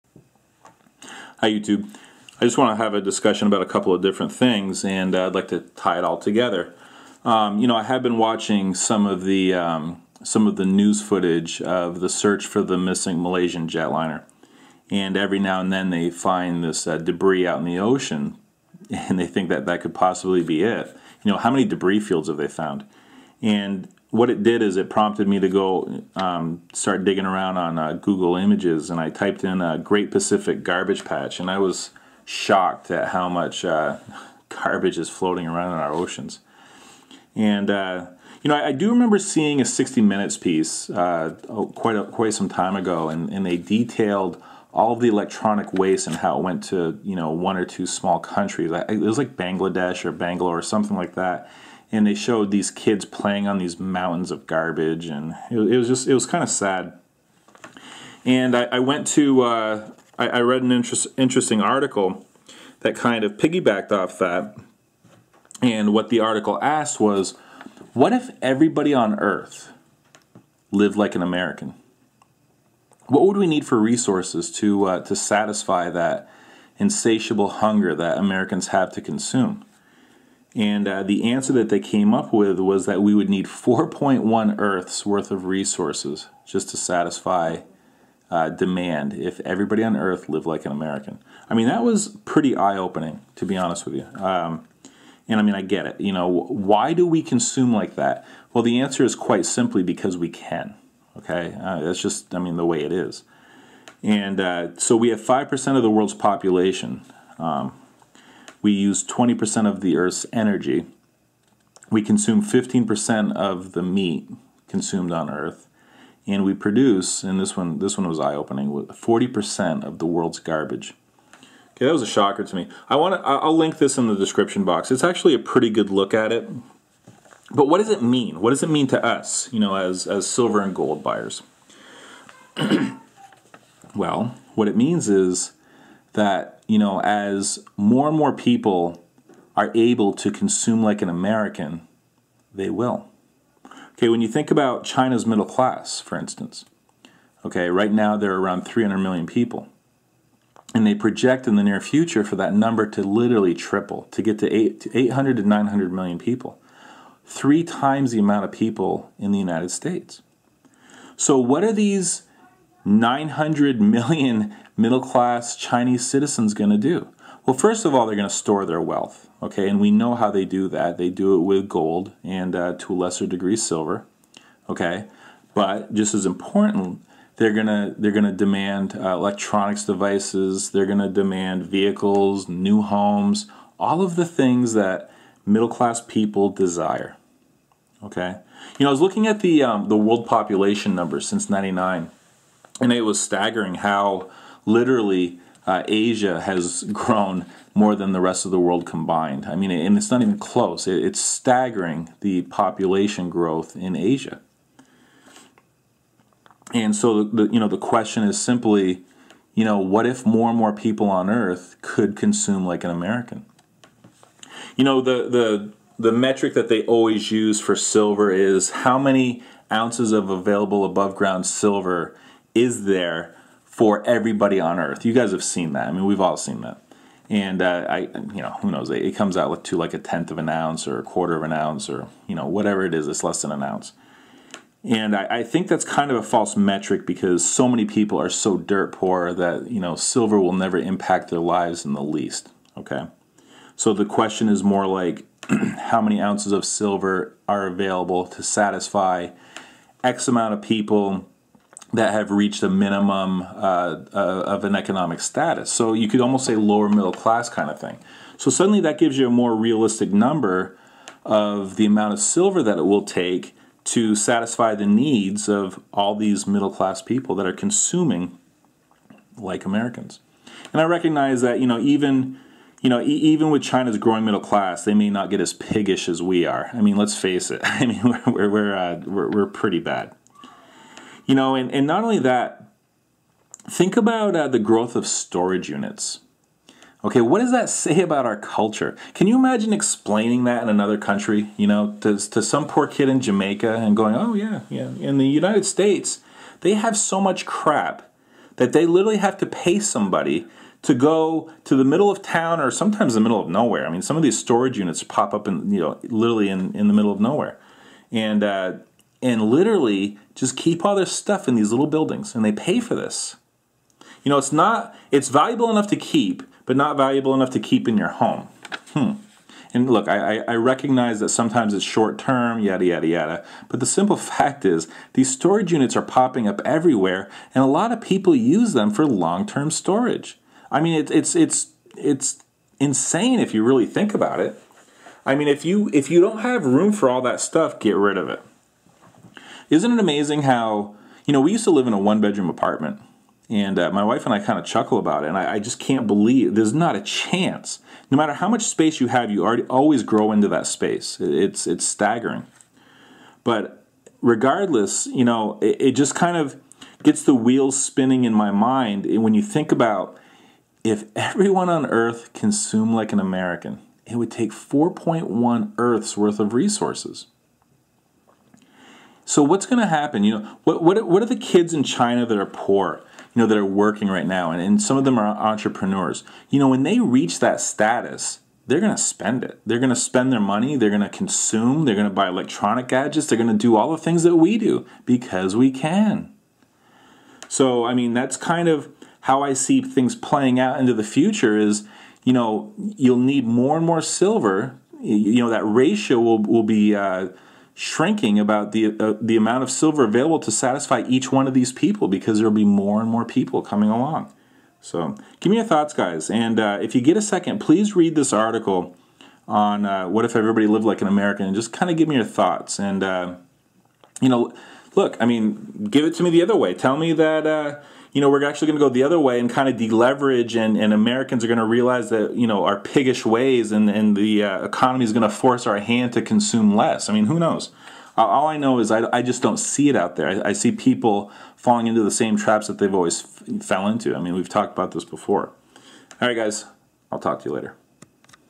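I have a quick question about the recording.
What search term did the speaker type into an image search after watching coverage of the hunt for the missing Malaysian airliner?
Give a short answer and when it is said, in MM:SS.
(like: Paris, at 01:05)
Great Pacific Garbage Patch, at 00:29.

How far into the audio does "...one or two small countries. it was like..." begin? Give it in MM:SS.
00:47.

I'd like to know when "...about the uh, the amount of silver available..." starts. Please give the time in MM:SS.
06:38.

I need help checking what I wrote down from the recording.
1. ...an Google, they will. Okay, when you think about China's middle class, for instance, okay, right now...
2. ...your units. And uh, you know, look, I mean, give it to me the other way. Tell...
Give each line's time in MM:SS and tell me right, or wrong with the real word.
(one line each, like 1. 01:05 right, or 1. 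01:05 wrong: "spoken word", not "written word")
1. 02:21 wrong: "American", not "Google"
2. 06:52 wrong: "thoughts", not "units".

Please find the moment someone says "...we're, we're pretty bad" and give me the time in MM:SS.
04:39.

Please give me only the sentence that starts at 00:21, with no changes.
You know, how many debris fields have they found?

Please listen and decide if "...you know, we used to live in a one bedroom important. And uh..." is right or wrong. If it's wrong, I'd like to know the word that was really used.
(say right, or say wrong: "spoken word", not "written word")
wrong: "apartment", not "important".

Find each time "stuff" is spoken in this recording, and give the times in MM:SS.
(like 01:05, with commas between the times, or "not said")
05:11, 05:37.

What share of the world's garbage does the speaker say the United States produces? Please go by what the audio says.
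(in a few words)
40%.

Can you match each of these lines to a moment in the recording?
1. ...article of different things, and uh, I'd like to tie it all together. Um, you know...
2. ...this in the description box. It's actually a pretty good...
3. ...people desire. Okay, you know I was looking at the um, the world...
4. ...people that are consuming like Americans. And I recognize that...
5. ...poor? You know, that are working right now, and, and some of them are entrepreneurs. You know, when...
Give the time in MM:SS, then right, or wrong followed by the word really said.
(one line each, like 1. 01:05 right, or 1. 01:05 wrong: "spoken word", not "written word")
1. 00:03 wrong: "couple", not "article"
2. 02:03 right
3. 03:06 right
4. 04:27 right
5. 06:12 right.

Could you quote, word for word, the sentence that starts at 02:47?
Well, first of all, they're going to store their wealth, okay?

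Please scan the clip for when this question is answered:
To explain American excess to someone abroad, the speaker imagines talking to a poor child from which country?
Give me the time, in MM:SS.
04:53.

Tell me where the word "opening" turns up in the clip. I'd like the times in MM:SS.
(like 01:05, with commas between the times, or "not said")
01:32, 01:58.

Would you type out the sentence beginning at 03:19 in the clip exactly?
I mean, and it's not even close.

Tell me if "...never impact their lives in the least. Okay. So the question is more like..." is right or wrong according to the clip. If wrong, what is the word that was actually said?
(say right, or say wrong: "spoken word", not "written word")
right.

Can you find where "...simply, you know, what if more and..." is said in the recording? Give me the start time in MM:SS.
03:28.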